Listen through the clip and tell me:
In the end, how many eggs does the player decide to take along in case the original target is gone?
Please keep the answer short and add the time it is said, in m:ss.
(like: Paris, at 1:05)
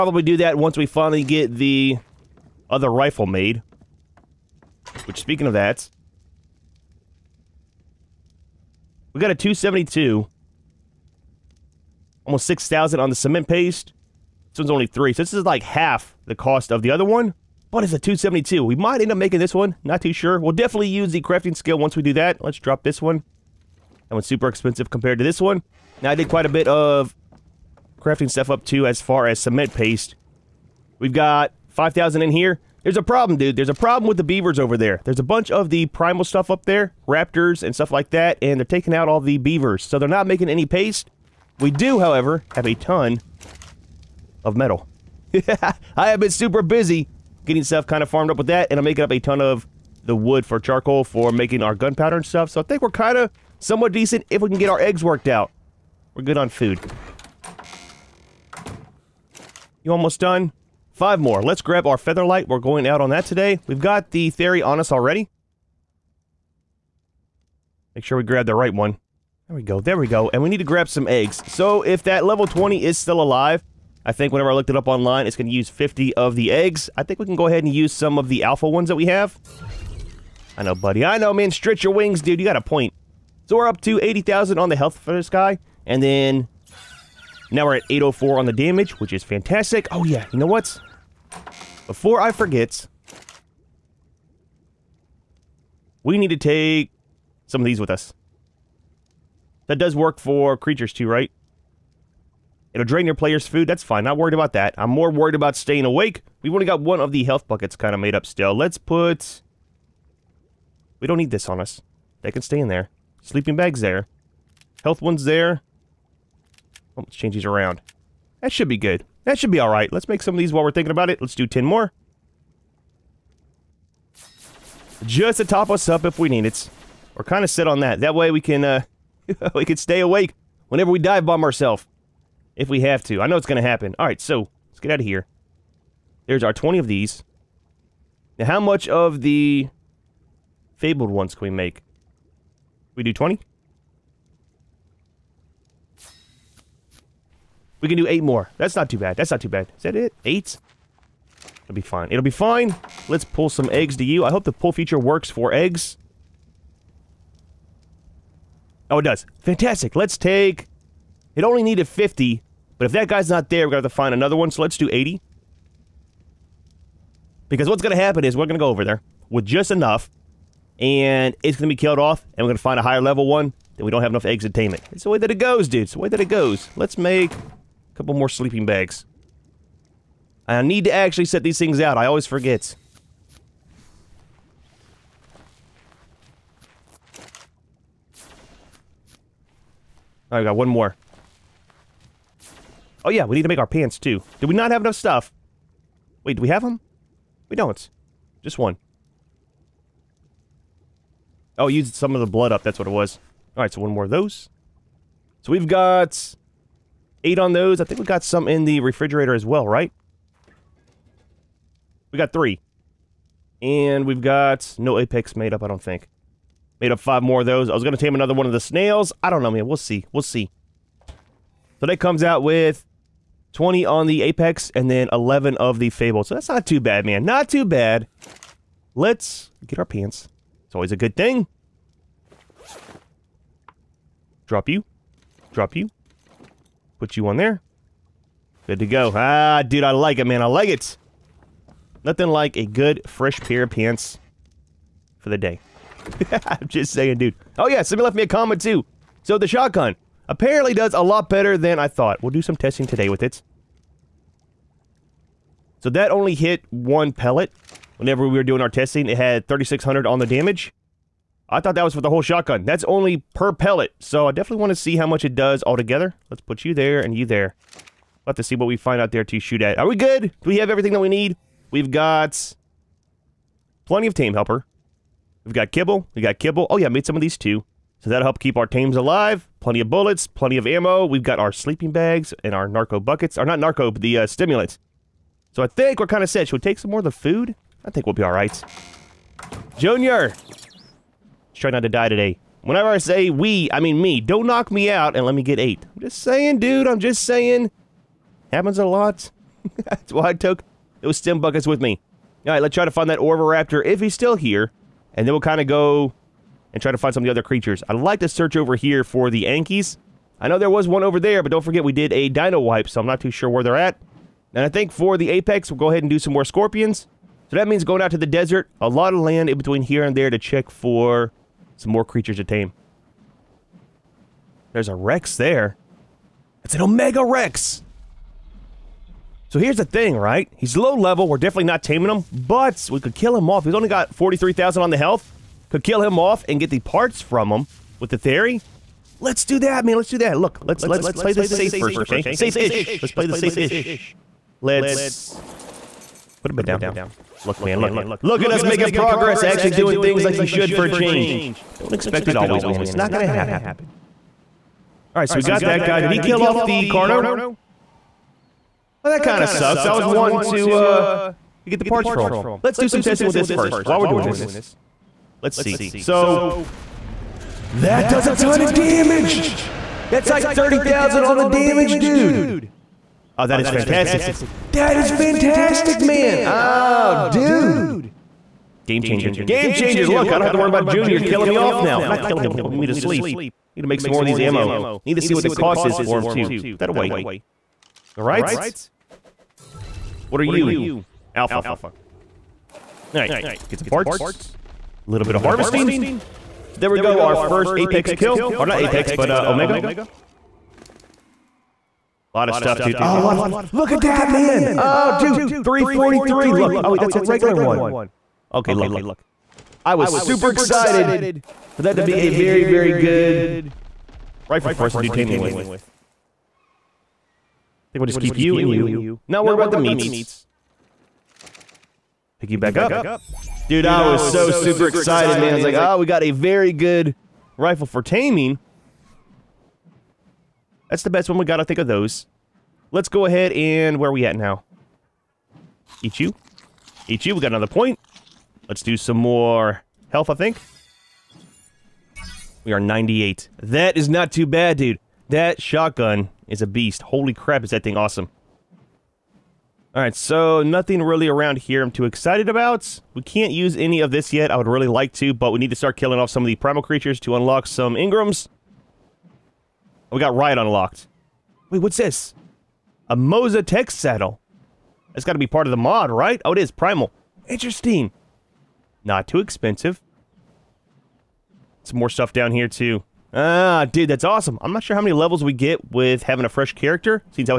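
80, at 2:44.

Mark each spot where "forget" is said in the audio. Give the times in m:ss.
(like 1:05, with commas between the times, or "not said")
1:32, 3:02, 5:11.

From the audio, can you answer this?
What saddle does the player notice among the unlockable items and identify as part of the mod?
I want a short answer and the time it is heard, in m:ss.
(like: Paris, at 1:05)
Moza Tech Saddle, at 7:43.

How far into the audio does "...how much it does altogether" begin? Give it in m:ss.
4:24.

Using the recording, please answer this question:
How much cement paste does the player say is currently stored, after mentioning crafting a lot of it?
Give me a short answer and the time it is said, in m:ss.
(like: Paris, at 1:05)
5,000, at 0:31.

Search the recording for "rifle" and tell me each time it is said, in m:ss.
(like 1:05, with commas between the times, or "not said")
0:02, 6:54, 7:07.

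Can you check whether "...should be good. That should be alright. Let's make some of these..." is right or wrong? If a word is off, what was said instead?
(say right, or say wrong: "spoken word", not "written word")
right.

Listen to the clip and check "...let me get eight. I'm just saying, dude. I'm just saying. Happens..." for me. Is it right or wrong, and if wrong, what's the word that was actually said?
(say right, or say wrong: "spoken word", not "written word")
right.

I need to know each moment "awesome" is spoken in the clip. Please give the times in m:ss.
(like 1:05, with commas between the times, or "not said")
7:27, 7:54.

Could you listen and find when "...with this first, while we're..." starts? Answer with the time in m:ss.
6:03.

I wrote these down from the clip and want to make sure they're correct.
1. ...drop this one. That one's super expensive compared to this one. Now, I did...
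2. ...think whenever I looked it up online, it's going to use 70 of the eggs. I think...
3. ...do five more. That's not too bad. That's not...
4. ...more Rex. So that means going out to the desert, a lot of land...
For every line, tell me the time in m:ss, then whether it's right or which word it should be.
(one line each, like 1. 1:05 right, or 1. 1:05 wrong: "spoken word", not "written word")
1. 0:22 right
2. 1:14 wrong: "50", not "70"
3. 2:27 wrong: "eight", not "five"
4. 5:16 wrong: "Scorpions", not "Rex".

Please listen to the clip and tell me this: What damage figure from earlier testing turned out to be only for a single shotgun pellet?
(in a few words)
3,600.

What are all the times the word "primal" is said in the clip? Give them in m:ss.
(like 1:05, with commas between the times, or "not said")
0:35, 7:36, 7:46.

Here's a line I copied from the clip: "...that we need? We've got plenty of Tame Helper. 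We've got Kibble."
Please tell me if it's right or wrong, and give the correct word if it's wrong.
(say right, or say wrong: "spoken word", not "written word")
right.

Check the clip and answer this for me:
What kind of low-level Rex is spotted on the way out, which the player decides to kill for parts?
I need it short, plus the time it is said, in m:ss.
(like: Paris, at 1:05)
Omega Rex, at 5:26.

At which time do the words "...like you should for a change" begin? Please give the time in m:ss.
5:50.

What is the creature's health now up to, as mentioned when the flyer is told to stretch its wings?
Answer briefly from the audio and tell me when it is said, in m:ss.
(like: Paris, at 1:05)
80,000, at 1:24.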